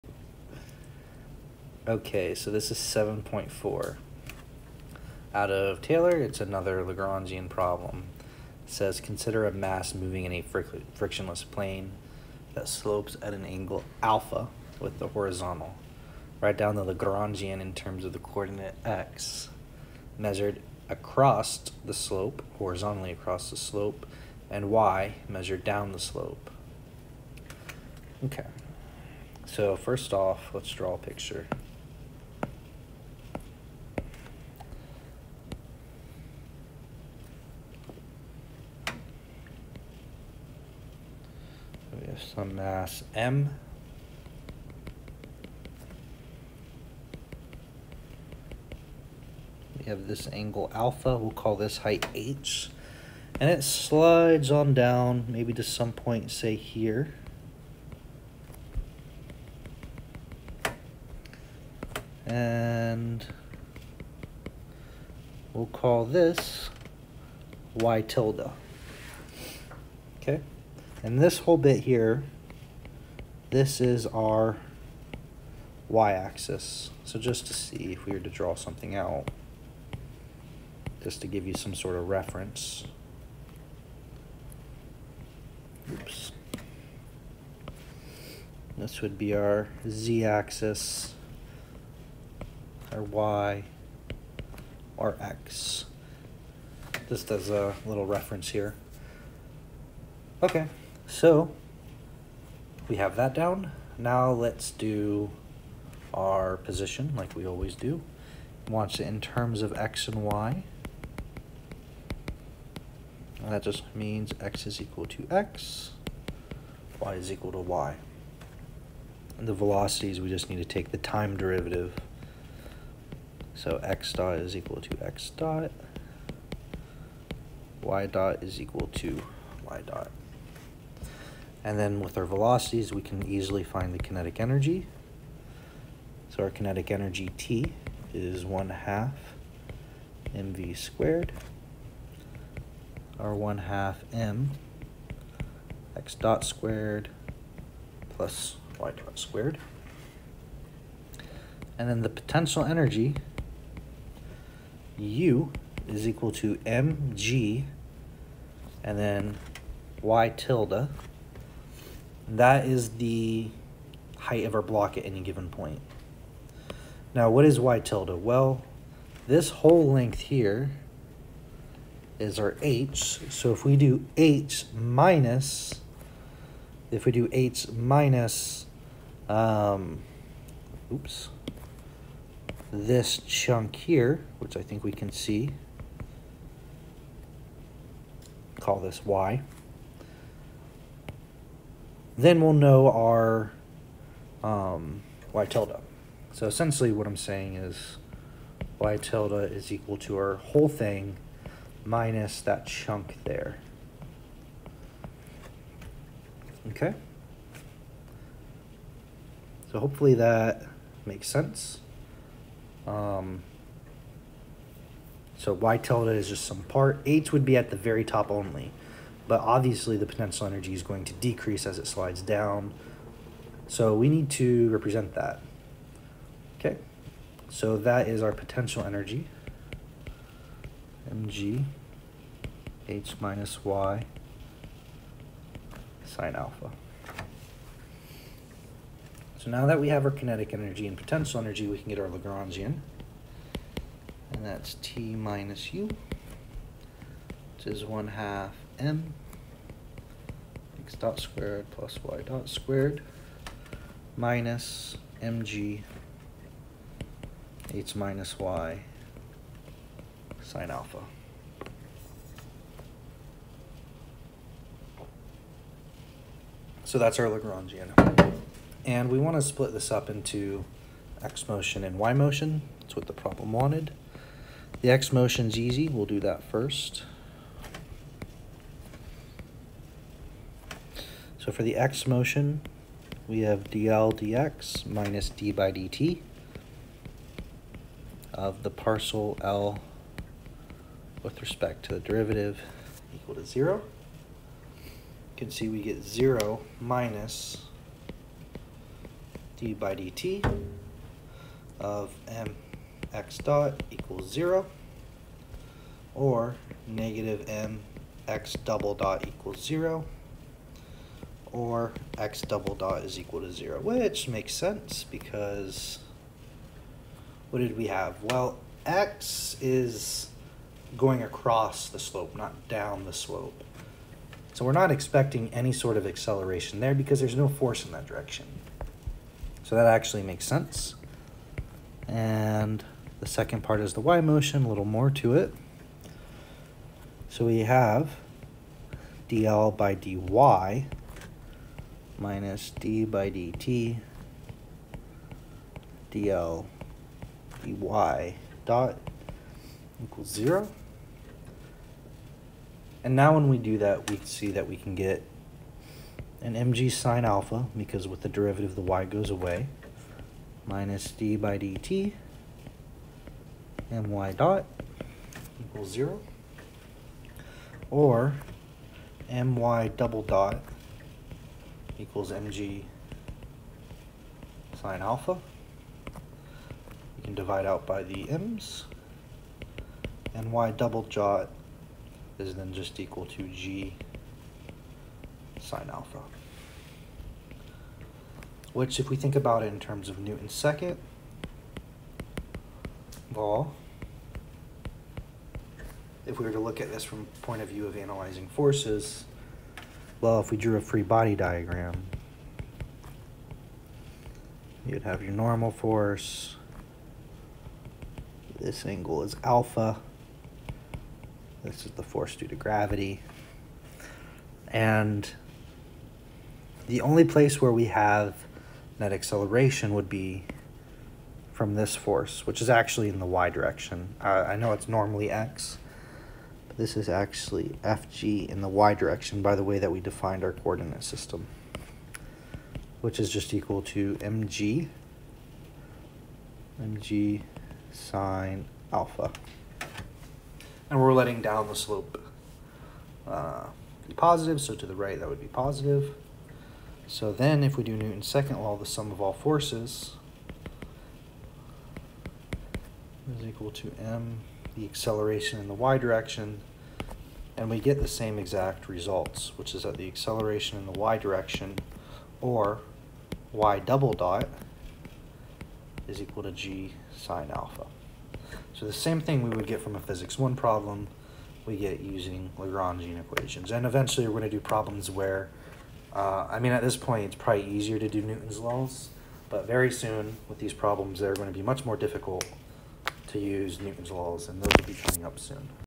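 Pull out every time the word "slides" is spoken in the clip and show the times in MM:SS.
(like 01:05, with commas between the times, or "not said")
00:53, 03:41.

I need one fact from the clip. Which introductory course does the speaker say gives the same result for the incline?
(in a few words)
physics 1.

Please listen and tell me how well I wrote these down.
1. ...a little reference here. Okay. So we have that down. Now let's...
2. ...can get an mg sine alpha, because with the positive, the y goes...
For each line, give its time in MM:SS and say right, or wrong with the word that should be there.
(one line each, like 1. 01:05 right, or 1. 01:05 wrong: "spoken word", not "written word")
1. 01:37 right
2. 05:54 wrong: "derivative", not "positive".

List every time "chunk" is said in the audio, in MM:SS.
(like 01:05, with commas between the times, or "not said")
03:03, 03:22.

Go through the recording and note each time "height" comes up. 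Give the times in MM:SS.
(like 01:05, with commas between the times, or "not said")
00:51, 02:44.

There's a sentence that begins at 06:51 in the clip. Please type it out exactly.
This is the force due to gravity.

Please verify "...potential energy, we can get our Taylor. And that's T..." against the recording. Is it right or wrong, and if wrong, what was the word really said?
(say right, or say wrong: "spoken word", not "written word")
wrong: "Lagrangian", not "Taylor".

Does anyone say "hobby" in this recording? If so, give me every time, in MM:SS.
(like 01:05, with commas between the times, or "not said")
not said.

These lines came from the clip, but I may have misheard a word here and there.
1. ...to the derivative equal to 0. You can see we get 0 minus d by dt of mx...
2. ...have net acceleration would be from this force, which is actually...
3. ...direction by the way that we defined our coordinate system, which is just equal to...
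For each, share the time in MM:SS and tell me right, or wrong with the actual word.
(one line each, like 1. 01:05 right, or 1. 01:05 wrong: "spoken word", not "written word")
1. 04:51 right
2. 06:57 right
3. 07:08 right.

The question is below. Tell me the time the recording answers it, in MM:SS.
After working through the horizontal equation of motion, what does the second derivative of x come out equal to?
05:12.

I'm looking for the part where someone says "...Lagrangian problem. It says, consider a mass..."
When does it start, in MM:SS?
00:06.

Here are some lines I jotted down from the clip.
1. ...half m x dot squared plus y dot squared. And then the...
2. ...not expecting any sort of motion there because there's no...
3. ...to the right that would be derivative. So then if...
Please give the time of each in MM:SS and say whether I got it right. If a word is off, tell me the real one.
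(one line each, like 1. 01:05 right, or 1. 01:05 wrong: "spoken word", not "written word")
1. 02:23 right
2. 05:24 wrong: "acceleration", not "motion"
3. 07:24 wrong: "positive", not "derivative".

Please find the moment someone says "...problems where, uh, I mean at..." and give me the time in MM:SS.
07:54.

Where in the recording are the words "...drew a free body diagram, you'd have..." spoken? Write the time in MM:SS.
06:40.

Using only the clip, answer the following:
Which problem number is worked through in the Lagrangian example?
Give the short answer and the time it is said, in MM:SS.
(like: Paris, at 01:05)
7.4, at 00:02.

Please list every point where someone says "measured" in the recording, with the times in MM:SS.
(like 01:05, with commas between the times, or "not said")
00:20, 00:25.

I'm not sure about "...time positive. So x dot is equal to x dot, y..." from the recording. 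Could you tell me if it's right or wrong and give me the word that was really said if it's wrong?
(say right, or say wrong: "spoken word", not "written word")
wrong: "derivative", not "positive".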